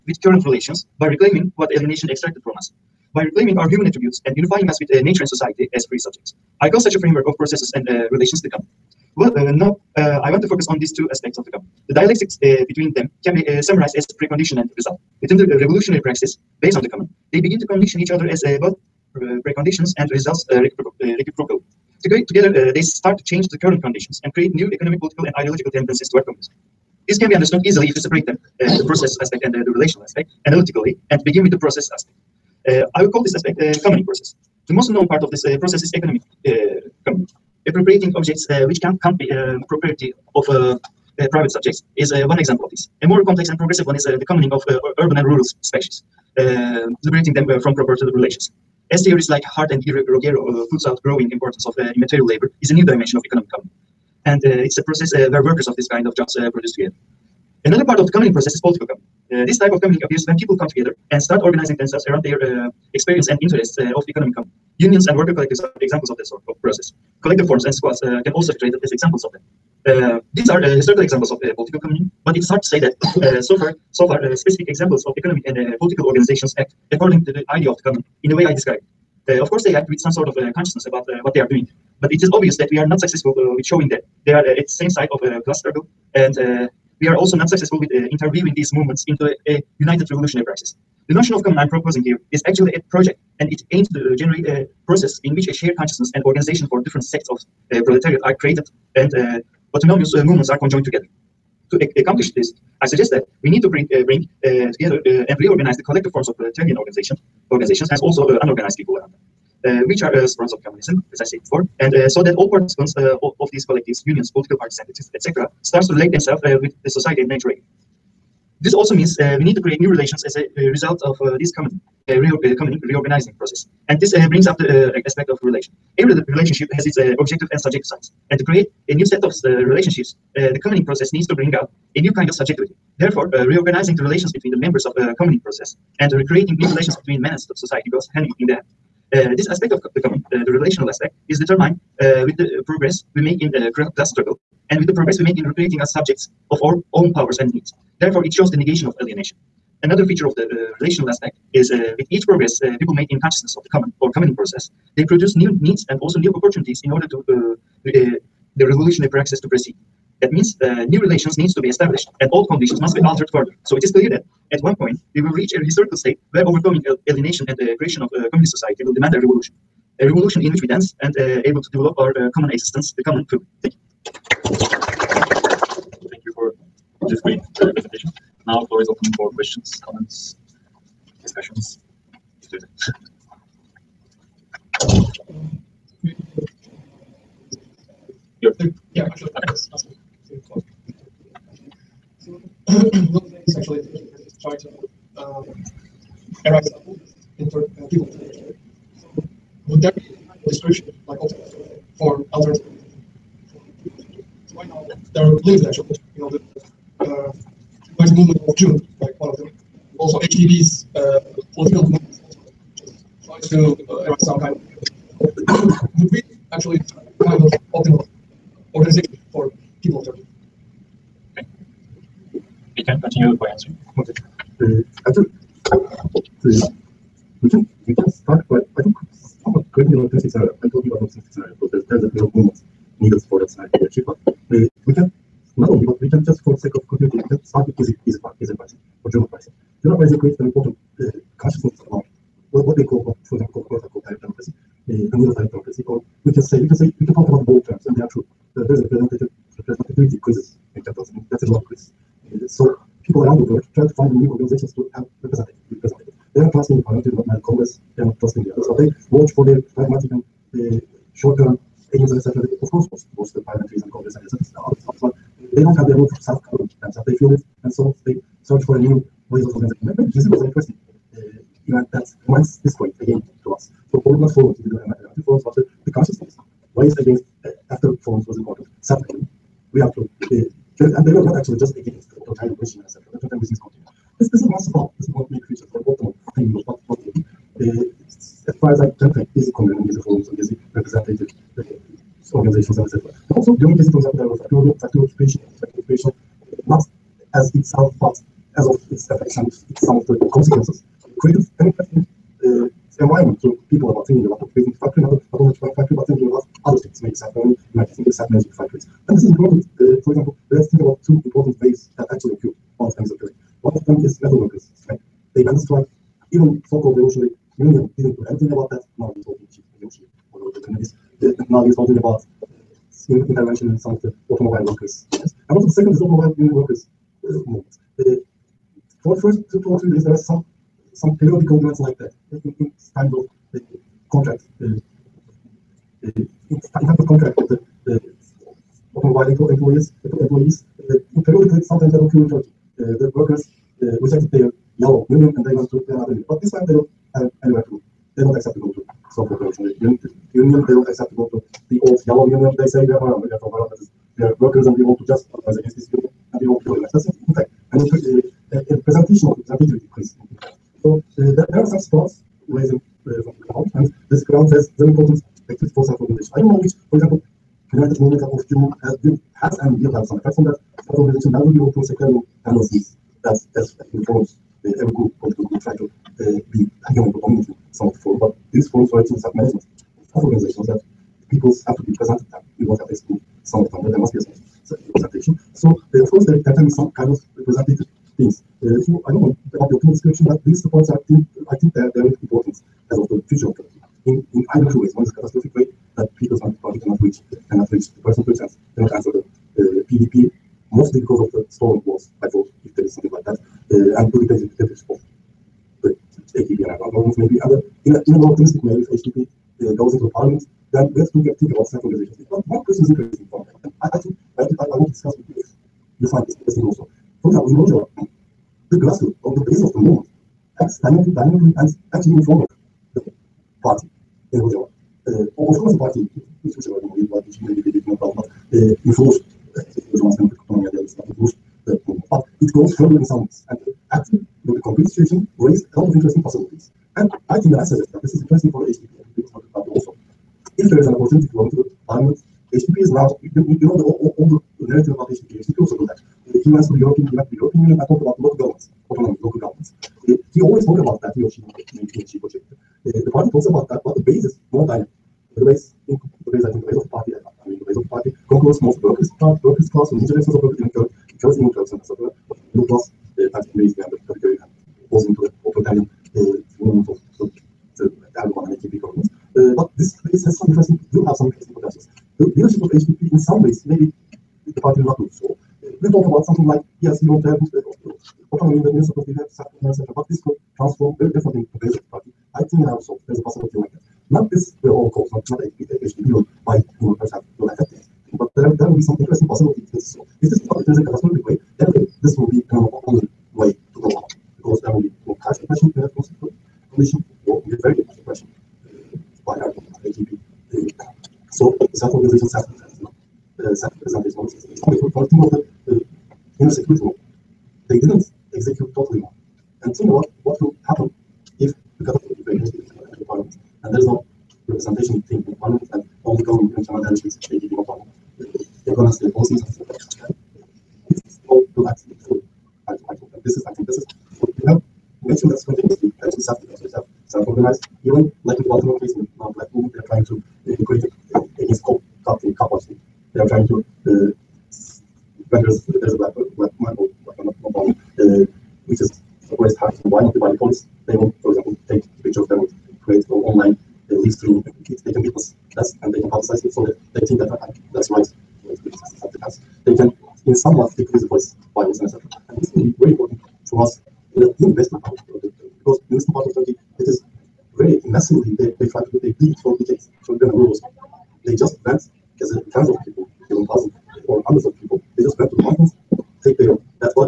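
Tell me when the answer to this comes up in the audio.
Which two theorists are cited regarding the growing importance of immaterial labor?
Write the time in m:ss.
0:49.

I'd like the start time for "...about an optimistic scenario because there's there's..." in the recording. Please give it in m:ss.
3:50.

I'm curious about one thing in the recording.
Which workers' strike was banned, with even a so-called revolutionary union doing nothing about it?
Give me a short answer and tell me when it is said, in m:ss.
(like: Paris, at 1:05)
metal workers strike, at 5:14.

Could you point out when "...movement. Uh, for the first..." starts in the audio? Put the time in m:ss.
5:27.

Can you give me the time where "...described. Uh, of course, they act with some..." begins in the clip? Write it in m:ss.
1:18.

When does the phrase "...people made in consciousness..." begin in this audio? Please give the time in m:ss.
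2:32.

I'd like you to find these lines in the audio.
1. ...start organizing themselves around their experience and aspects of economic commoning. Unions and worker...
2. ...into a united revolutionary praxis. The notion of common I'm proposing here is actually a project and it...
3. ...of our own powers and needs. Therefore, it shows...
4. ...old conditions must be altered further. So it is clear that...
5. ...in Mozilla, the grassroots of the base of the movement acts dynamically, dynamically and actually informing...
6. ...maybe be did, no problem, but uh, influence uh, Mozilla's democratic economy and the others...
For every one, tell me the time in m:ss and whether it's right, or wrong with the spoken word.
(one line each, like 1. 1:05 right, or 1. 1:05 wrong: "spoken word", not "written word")
1. 1:01 wrong: "interests", not "aspects"
2. 1:29 right
3. 2:26 right
4. 2:42 right
5. 6:57 right
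6. 7:07 right.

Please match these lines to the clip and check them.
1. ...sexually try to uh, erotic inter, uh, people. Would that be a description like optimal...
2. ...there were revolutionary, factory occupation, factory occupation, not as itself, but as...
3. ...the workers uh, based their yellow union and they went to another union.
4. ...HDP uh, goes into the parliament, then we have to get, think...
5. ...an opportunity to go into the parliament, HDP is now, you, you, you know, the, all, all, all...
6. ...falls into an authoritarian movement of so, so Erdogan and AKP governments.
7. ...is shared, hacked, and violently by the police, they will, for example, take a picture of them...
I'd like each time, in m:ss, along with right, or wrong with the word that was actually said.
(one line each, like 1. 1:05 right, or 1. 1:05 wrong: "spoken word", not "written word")
1. 3:13 right
2. 4:54 wrong: "factory", not "revolutionary"
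3. 5:43 wrong: "rejected", not "based"
4. 6:48 right
5. 7:20 right
6. 7:44 right
7. 8:58 wrong: "oppressed", not "shared".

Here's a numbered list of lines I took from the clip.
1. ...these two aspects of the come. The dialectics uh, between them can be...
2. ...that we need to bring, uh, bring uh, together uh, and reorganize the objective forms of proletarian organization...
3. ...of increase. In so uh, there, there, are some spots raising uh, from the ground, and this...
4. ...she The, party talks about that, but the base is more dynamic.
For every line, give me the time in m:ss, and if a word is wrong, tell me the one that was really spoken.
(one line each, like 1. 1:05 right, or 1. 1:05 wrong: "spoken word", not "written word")
1. 0:10 right
2. 1:43 wrong: "collective", not "objective"
3. 5:59 right
4. 7:32 right.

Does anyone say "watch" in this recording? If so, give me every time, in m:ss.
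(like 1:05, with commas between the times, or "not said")
4:19.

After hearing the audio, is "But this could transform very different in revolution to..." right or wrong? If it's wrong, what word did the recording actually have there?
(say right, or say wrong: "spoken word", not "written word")
wrong: "comparison", not "revolution".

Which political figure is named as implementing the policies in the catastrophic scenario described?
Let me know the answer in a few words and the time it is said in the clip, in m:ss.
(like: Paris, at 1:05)
Kemal Dervish, at 8:36.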